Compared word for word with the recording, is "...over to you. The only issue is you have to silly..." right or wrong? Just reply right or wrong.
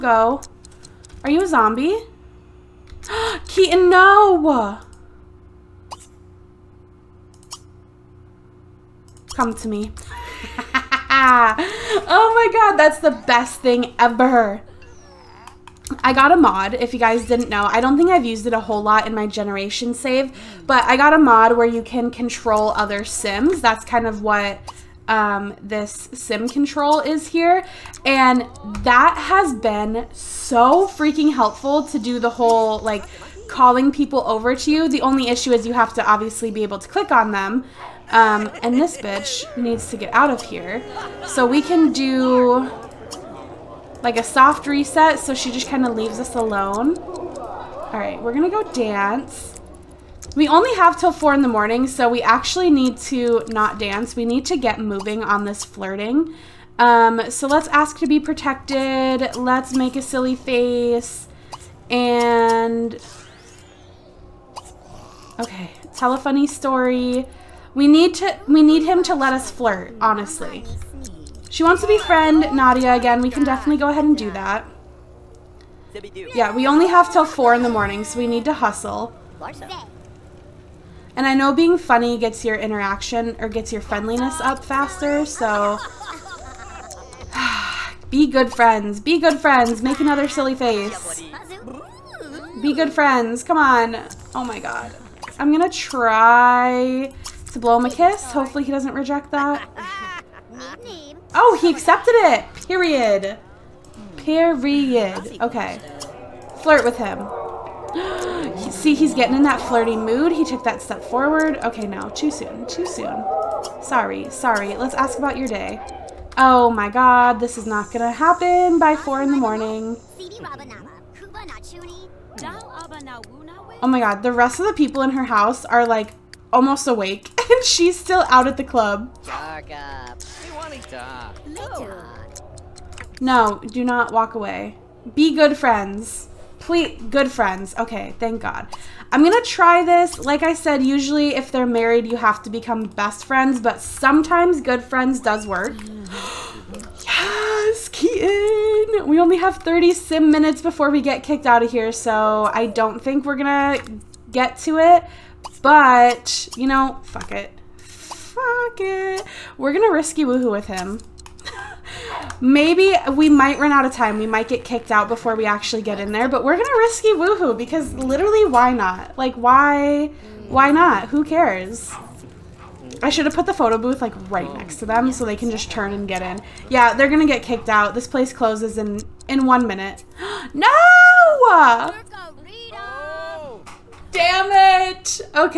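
wrong.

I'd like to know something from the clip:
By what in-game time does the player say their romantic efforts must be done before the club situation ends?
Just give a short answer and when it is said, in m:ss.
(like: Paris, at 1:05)
4 in the morning, at 0:51.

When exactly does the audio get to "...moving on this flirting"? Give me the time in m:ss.
0:54.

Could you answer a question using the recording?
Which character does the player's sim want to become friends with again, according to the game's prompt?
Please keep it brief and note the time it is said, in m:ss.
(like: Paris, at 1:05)
Nadia, at 1:12.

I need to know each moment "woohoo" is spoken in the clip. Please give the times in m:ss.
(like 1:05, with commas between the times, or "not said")
2:40, 2:47.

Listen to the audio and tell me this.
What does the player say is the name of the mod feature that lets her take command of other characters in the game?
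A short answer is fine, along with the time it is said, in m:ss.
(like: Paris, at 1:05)
sim control, at 0:26.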